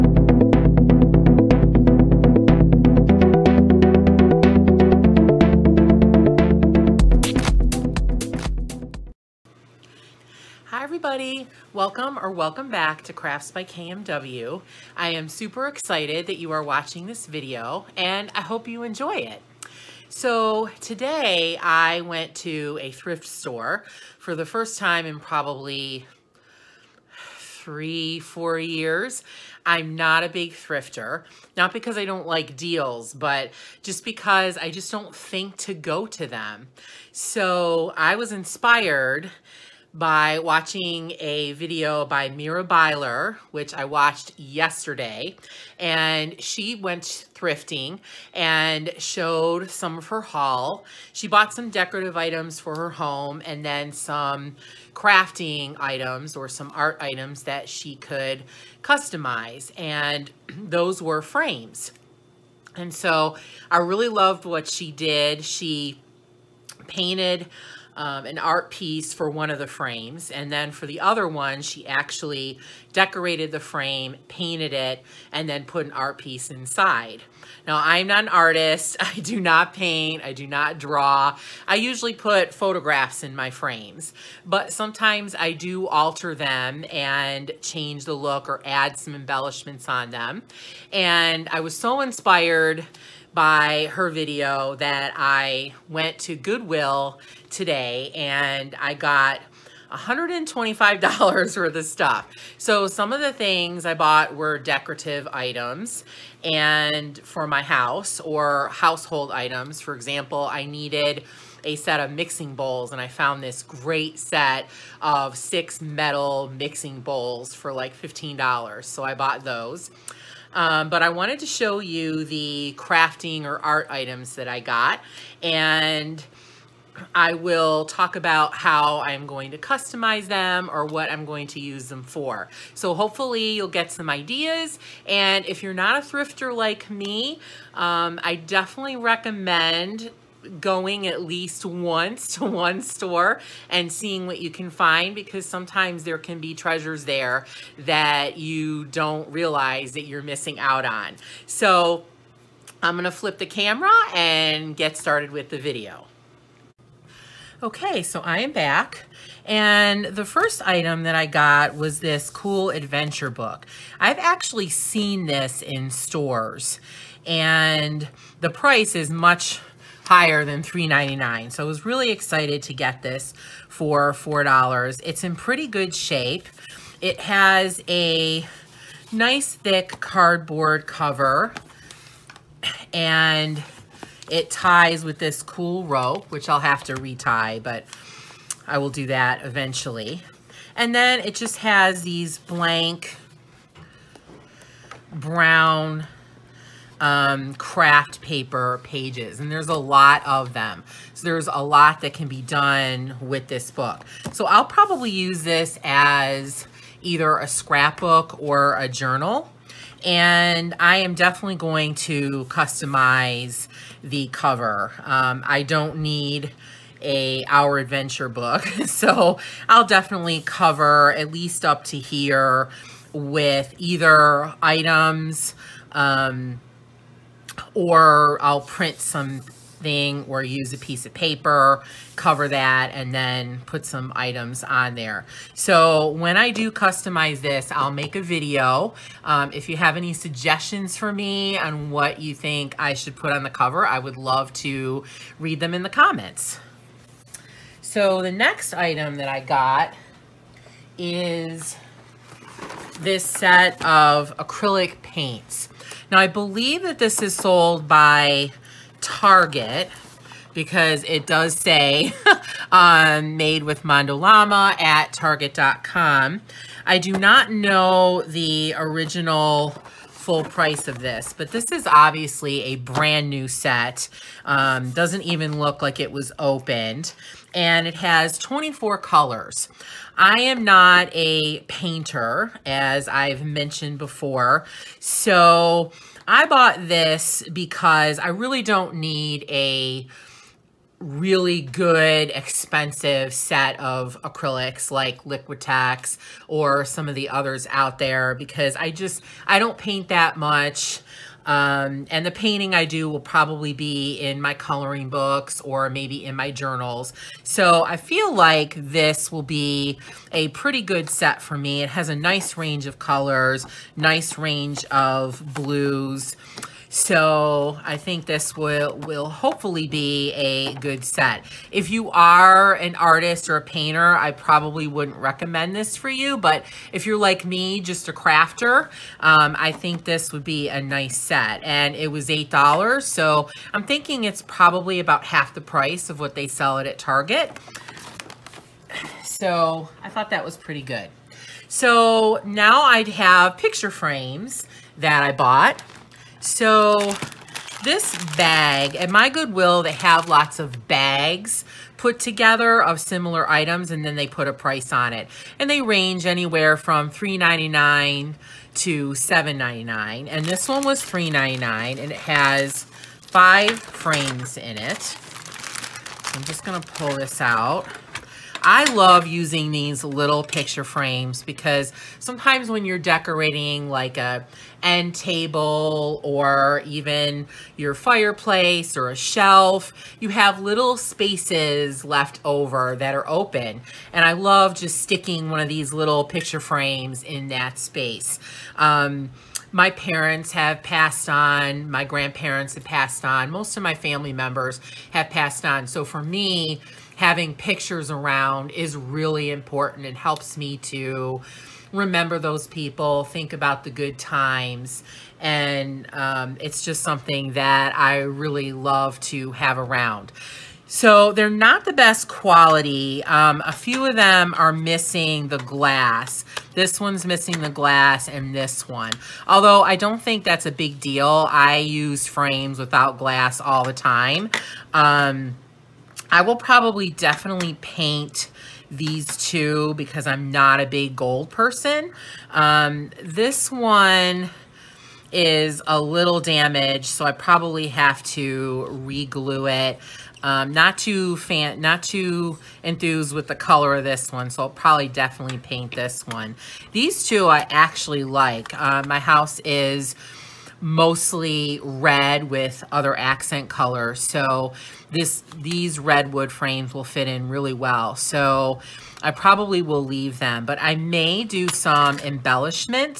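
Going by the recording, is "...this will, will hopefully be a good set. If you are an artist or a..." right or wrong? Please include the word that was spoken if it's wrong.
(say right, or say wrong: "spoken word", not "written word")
right.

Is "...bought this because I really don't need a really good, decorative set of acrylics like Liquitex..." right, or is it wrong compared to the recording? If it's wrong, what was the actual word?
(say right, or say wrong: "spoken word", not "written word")
wrong: "expensive", not "decorative".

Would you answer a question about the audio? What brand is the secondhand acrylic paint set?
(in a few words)
Mondo Llama.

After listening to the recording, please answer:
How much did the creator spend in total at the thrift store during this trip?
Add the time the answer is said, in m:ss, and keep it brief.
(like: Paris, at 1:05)
$125, at 1:39.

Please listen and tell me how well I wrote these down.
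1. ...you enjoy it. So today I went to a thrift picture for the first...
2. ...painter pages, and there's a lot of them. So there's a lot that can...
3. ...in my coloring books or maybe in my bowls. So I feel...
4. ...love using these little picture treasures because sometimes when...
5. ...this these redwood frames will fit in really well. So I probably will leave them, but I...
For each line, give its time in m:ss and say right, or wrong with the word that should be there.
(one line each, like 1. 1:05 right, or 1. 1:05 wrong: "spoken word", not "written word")
1. 0:18 wrong: "store", not "picture"
2. 3:18 wrong: "paper", not "painter"
3. 5:04 wrong: "journals", not "bowls"
4. 6:08 wrong: "frames", not "treasures"
5. 7:35 right.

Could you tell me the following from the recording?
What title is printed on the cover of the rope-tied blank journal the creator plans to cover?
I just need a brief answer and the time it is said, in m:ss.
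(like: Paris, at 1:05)
Our Adventure, at 3:37.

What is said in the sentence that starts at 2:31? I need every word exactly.
So I'm gonna flip the camera and get started with the video.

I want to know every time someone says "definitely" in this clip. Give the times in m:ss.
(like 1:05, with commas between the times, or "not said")
2:18, 3:31, 3:39, 7:07, 7:25.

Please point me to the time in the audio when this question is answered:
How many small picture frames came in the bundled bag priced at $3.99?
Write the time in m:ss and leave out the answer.
6:03.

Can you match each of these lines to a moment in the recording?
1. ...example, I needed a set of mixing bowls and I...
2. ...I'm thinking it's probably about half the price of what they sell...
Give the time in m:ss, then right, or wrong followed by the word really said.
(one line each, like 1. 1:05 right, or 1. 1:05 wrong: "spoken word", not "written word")
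1. 1:49 right
2. 5:33 right.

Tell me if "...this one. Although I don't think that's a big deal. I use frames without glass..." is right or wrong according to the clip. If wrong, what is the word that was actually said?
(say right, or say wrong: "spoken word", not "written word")
right.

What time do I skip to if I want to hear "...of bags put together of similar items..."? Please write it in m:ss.
5:50.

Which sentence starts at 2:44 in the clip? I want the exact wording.
I've actually seen this in stores and the price is much higher than $3.99.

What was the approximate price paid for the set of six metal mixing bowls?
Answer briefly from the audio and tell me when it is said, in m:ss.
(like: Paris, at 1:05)
$15, at 1:57.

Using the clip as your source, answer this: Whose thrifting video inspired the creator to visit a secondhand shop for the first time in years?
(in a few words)
Mira Byler.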